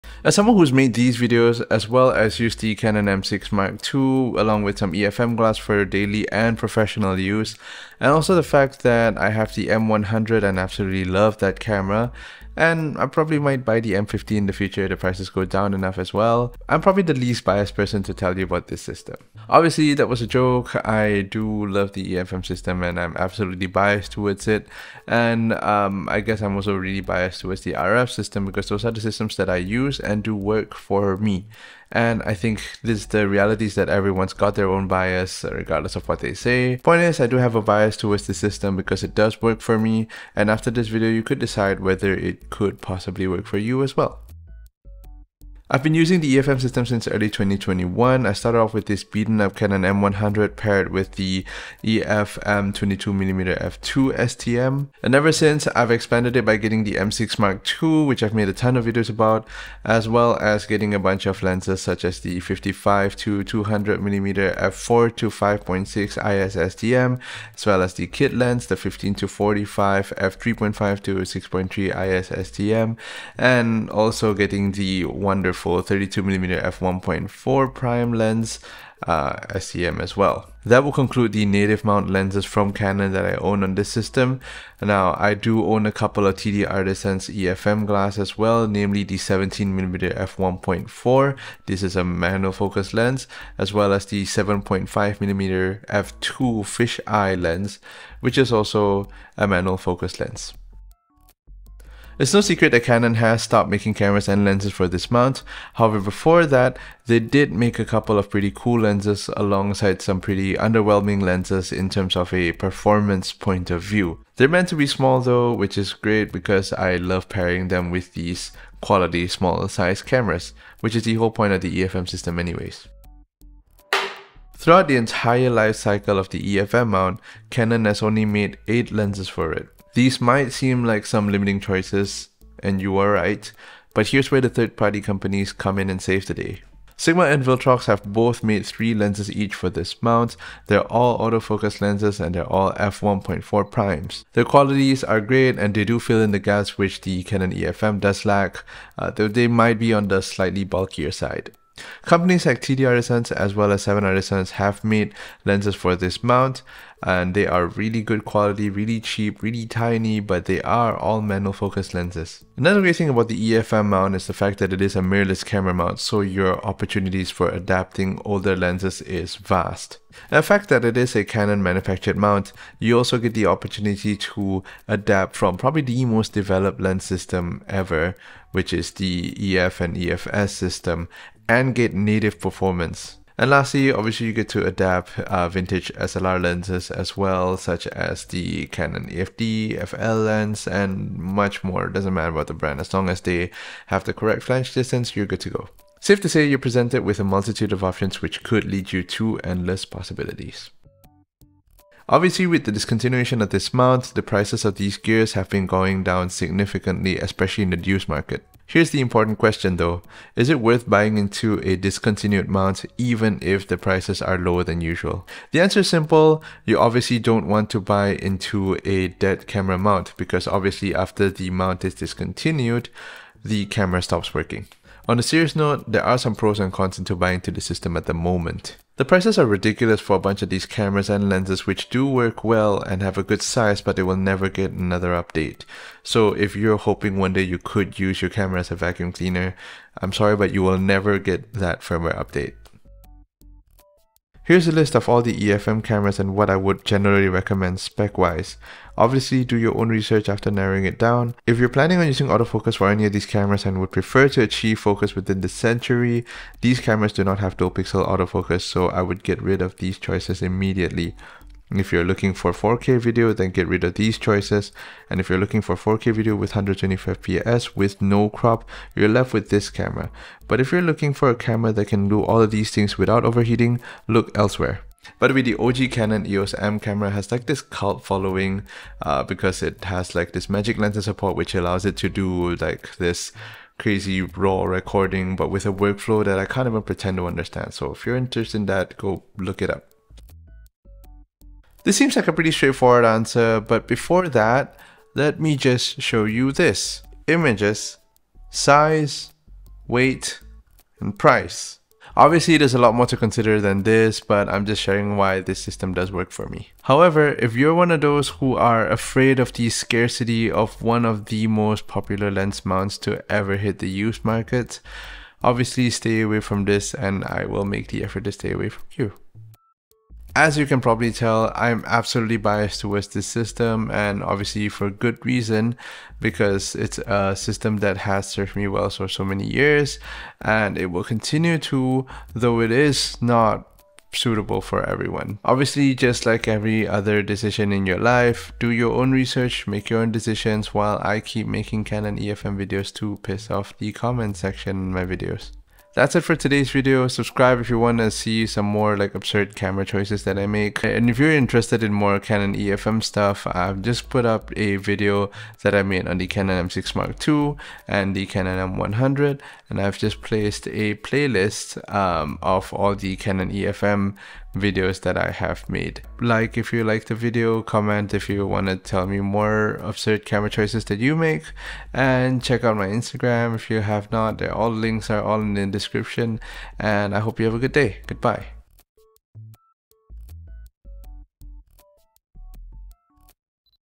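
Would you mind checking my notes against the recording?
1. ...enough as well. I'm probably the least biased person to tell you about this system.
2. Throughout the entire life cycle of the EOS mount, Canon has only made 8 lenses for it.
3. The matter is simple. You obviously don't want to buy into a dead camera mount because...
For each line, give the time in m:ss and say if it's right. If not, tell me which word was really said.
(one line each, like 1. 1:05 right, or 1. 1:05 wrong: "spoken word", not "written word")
1. 0:15 right
2. 2:04 wrong: "EFM", not "EOS"
3. 3:35 wrong: "answer", not "matter".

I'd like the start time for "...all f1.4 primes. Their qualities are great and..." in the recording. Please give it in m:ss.
2:22.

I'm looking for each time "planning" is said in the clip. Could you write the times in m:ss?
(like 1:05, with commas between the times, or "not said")
4:11.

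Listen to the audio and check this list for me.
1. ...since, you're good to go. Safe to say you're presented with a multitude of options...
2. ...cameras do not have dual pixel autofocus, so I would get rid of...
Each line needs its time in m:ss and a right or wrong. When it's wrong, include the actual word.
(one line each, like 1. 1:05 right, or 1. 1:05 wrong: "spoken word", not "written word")
1. 3:14 wrong: "distance", not "since"
2. 4:16 right.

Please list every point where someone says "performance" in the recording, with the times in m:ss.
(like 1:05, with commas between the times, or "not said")
1:52, 3:02.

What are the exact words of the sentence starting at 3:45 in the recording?
On a serious note, there are some pros and cons into buying into the system at the moment.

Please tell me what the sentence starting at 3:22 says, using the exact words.
Obviously, with the discontinuation of this mount, the prices of these gears have been going down significantly, especially in the used market.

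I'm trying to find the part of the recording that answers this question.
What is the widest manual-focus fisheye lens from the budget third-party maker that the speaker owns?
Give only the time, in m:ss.
1:34.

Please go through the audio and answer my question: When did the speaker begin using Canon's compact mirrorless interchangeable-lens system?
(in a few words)
early 2021.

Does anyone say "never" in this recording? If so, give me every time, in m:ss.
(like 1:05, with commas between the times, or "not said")
3:54, 4:00.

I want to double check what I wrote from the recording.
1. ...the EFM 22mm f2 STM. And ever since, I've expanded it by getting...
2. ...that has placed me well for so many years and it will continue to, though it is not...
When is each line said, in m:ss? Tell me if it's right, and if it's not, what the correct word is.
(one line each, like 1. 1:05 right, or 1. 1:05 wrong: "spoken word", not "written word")
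1. 0:51 right
2. 5:27 wrong: "served", not "placed".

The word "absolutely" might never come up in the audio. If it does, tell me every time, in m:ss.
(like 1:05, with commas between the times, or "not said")
0:10, 0:23, 5:21.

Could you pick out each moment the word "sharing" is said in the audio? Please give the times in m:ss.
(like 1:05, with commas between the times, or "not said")
5:04.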